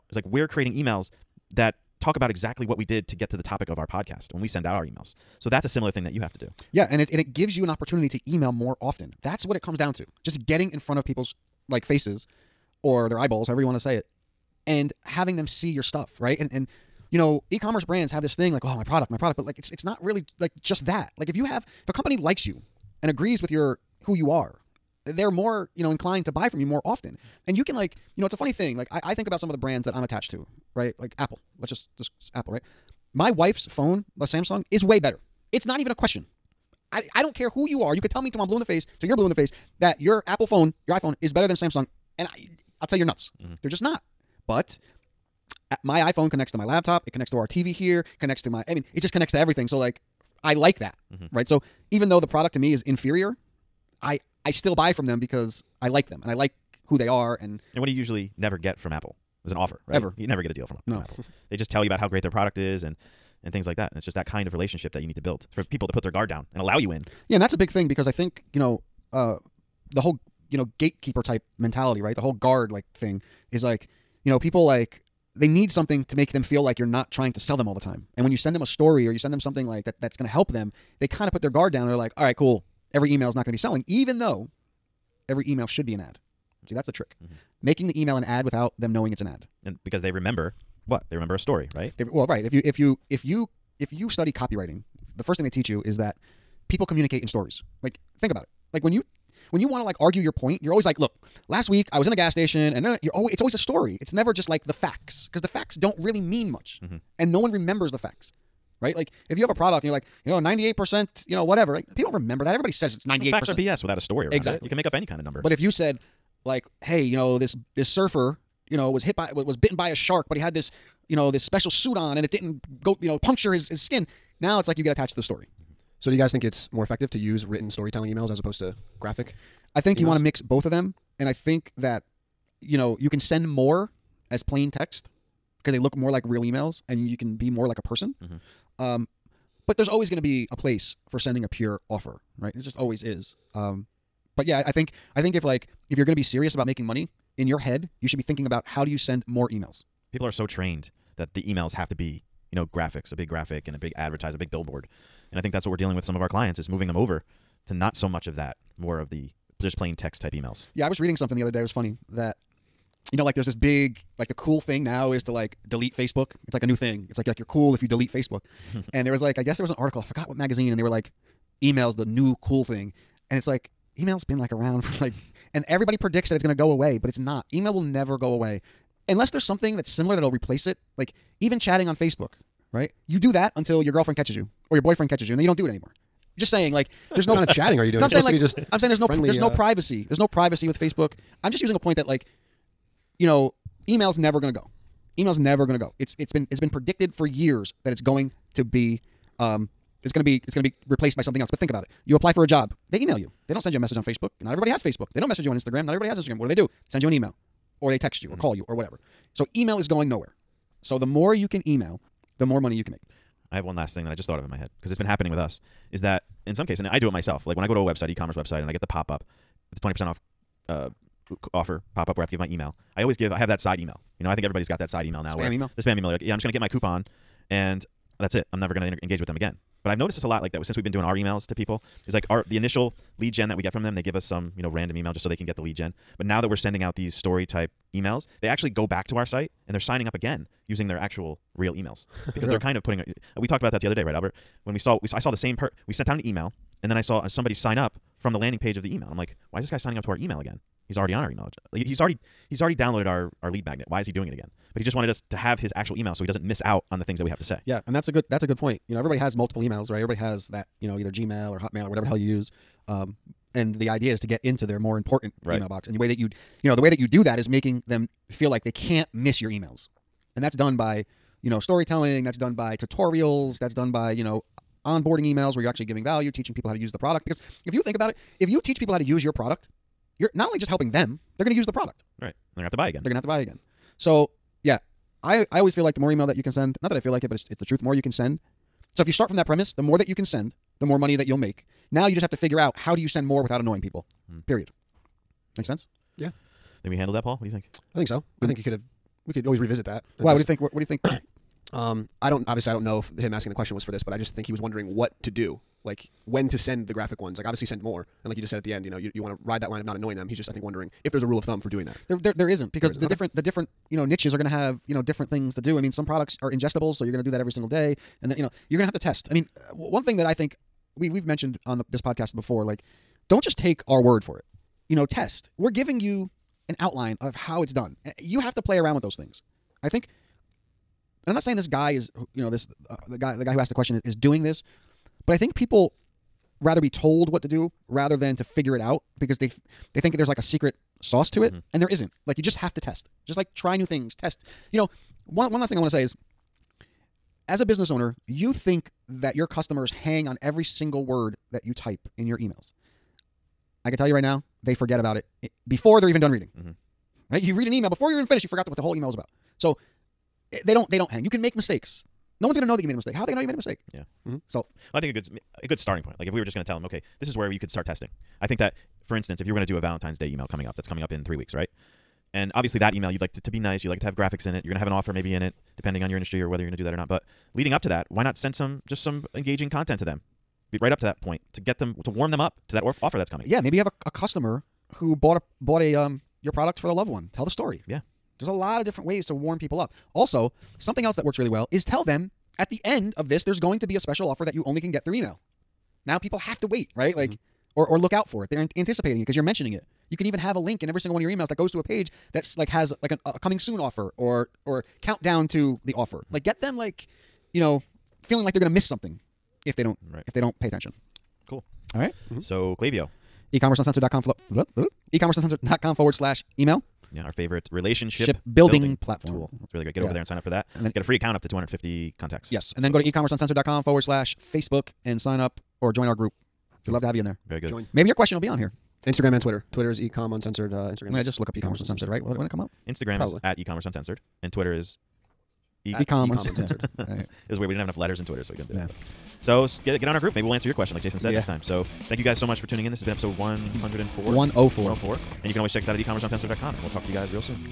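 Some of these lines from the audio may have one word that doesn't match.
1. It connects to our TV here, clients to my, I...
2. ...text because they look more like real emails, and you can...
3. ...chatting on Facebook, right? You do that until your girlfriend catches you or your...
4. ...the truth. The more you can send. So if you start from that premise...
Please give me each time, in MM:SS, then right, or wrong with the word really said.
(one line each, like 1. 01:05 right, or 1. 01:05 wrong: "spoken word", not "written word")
1. 00:47 wrong: "connects", not "clients"
2. 02:14 right
3. 03:01 right
4. 04:47 right.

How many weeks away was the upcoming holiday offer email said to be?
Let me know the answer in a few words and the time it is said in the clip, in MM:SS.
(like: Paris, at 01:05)
3 weeks, at 06:11.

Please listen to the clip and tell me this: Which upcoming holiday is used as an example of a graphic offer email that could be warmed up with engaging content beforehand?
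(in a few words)
Valentine's Day.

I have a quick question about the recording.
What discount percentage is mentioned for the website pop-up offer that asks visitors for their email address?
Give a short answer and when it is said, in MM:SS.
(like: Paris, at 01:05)
20%, at 03:39.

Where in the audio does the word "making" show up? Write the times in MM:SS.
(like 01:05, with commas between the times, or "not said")
01:27, 02:26, 04:27.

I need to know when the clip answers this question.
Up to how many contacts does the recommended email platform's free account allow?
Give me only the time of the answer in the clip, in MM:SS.
07:01.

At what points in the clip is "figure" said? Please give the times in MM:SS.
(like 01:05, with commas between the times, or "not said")
04:52, 05:38.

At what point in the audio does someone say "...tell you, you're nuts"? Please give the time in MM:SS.
00:42.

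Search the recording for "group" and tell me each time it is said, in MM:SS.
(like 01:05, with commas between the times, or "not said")
07:06, 07:20.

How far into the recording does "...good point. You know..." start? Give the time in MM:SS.
04:18.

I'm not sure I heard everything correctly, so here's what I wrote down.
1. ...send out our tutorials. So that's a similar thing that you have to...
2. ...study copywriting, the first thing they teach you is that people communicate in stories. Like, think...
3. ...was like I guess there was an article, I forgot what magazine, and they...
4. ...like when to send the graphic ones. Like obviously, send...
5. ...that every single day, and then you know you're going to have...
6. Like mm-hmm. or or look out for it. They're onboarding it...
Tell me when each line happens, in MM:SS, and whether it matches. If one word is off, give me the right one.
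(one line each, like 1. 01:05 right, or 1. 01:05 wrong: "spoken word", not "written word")
1. 00:04 wrong: "emails", not "tutorials"
2. 01:34 right
3. 02:49 right
4. 05:05 right
5. 05:17 right
6. 06:37 wrong: "anticipating", not "onboarding".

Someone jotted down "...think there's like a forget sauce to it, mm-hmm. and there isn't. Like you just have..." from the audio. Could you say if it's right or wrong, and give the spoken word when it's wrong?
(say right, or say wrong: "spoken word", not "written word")
wrong: "secret", not "forget".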